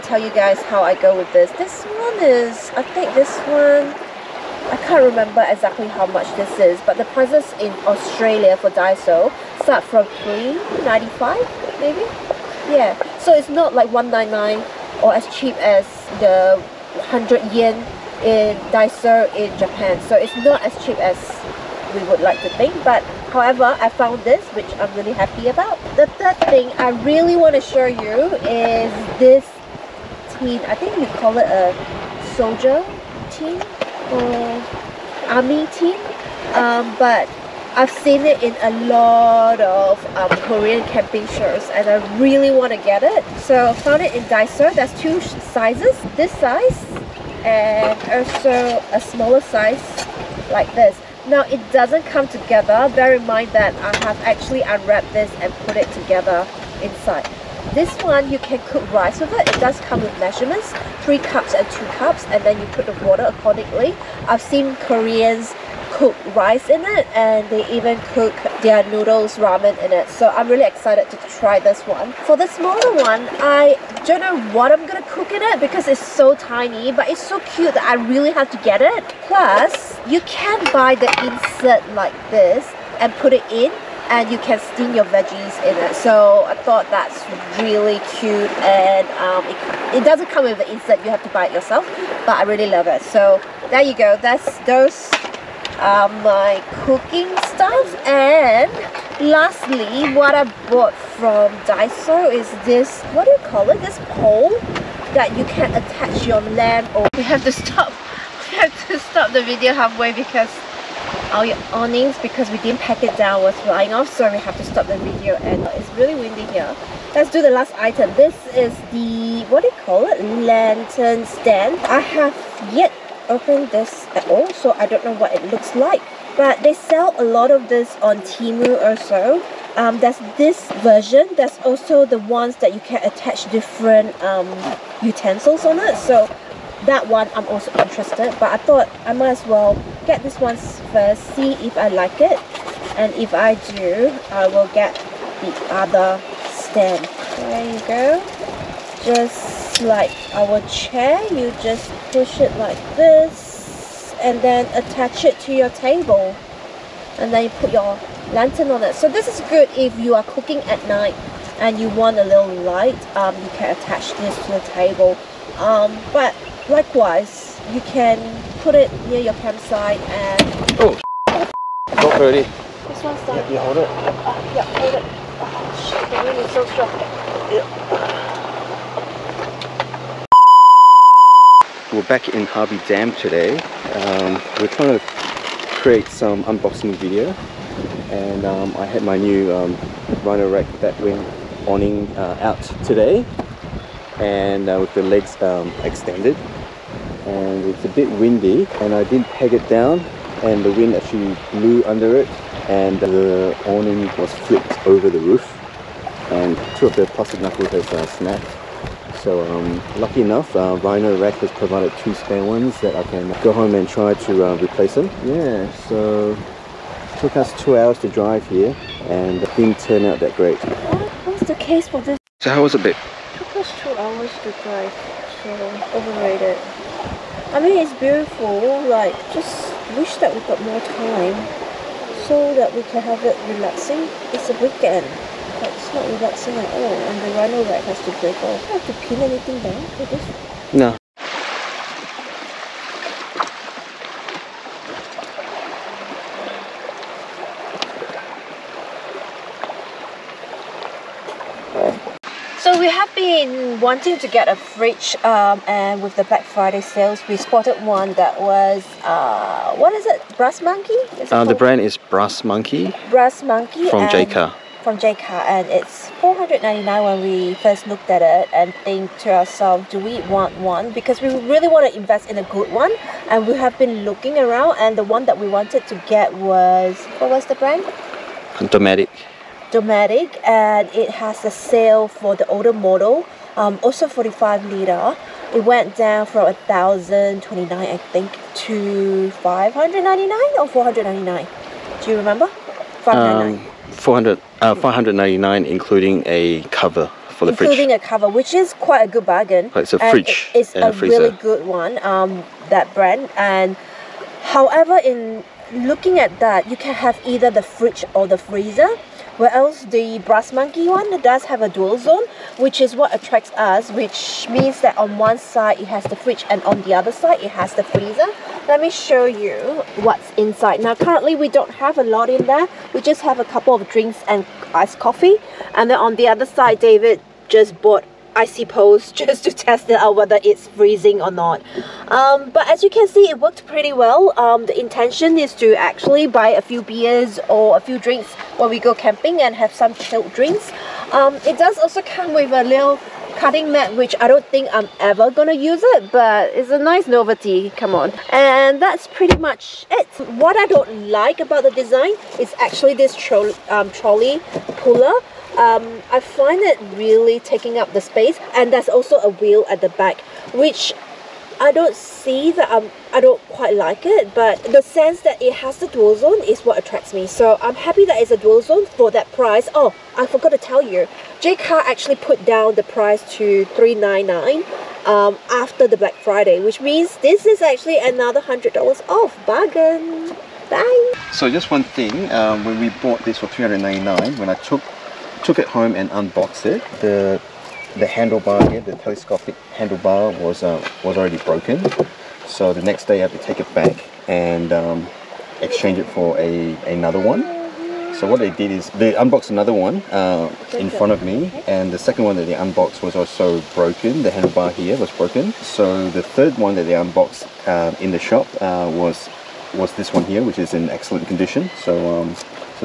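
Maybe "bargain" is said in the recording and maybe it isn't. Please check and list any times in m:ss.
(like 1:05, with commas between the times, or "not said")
4:59, 6:19.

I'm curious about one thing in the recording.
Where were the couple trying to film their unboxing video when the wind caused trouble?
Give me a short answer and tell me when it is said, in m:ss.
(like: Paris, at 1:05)
Harvey Dam, at 3:02.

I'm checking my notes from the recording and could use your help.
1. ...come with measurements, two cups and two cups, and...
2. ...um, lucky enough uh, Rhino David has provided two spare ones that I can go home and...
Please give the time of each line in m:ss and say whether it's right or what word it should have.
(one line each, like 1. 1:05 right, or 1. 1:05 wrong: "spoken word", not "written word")
1. 0:59 wrong: "three", not "two"
2. 3:29 wrong: "Rack", not "David".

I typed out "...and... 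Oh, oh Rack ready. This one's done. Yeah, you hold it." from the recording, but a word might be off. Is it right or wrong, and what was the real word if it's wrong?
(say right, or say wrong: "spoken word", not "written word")
wrong: "Not", not "Rack".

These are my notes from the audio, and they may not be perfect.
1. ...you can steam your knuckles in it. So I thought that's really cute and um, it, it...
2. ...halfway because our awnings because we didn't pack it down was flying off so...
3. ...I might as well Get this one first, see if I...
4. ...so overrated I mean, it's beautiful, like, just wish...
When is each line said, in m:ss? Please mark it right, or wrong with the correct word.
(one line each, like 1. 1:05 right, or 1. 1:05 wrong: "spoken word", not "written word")
1. 1:24 wrong: "veggies", not "knuckles"
2. 1:49 right
3. 2:19 right
4. 3:45 right.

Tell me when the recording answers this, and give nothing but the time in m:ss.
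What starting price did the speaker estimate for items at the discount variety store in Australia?
0:10.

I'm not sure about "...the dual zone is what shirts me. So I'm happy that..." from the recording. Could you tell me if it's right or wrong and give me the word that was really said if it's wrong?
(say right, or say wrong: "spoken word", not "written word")
wrong: "attracts", not "shirts".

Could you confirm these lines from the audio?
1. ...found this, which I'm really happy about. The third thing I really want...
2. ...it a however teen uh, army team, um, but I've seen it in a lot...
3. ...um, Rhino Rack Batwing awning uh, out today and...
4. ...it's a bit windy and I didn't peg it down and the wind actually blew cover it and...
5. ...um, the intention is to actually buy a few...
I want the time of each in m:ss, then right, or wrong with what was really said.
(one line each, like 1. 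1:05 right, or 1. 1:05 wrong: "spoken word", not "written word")
1. 0:23 right
2. 0:31 wrong: "soldier", not "however"
3. 3:09 right
4. 3:17 wrong: "under", not "cover"
5. 5:34 right.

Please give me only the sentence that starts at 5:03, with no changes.
And however, in looking at that, you can have either the fridge or the freezer.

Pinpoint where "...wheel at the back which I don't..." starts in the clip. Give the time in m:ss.
5:59.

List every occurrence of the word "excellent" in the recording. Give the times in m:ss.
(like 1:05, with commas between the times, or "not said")
6:50.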